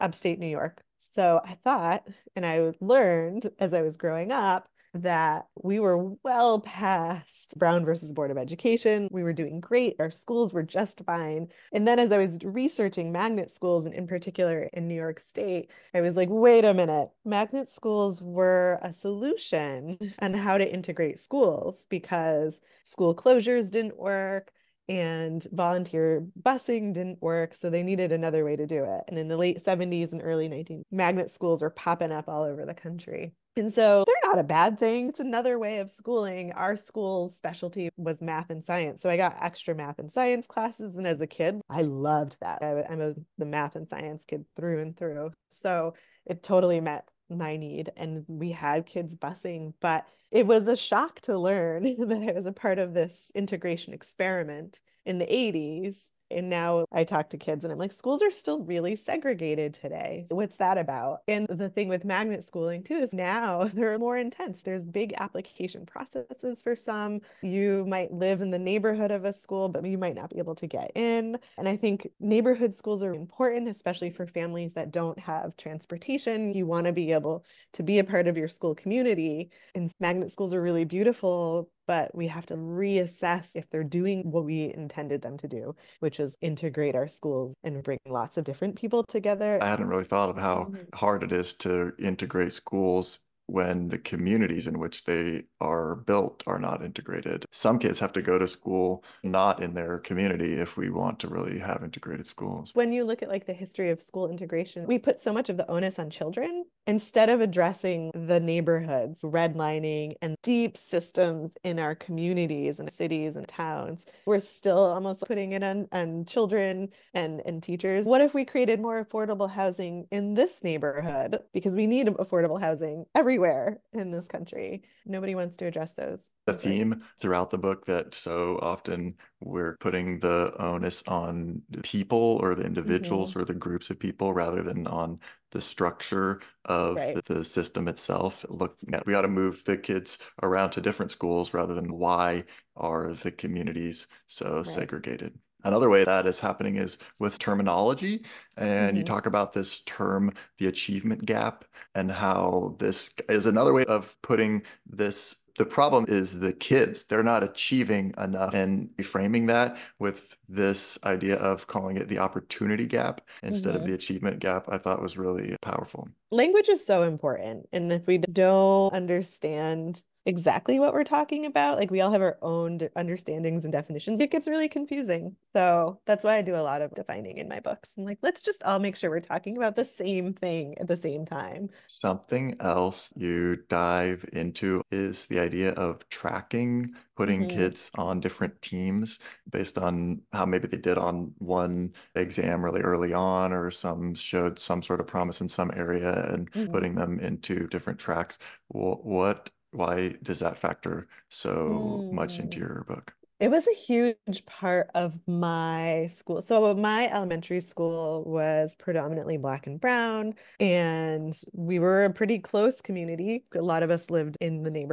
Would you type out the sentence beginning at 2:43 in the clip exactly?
of the achievement gap, I thought was really powerful.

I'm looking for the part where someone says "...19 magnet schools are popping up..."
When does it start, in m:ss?
0:30.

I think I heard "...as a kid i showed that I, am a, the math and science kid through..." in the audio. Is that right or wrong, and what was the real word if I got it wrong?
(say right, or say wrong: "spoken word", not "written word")
wrong: "loved", not "showed".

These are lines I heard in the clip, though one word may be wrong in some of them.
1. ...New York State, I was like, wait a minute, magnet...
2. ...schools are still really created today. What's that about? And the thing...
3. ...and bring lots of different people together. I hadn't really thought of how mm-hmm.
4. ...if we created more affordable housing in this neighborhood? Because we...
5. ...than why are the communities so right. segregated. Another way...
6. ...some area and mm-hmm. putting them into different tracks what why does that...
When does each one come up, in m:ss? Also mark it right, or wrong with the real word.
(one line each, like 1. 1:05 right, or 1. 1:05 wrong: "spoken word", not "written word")
1. 0:14 right
2. 0:57 wrong: "segregated", not "created"
3. 1:27 right
4. 1:58 right
5. 2:21 right
6. 3:15 right.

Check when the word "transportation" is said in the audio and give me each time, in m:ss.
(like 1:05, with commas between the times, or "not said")
1:15.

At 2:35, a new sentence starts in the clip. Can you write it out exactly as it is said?
The problem is the kids, they're not achieving enough.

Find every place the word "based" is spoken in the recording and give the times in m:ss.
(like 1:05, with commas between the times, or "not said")
3:09.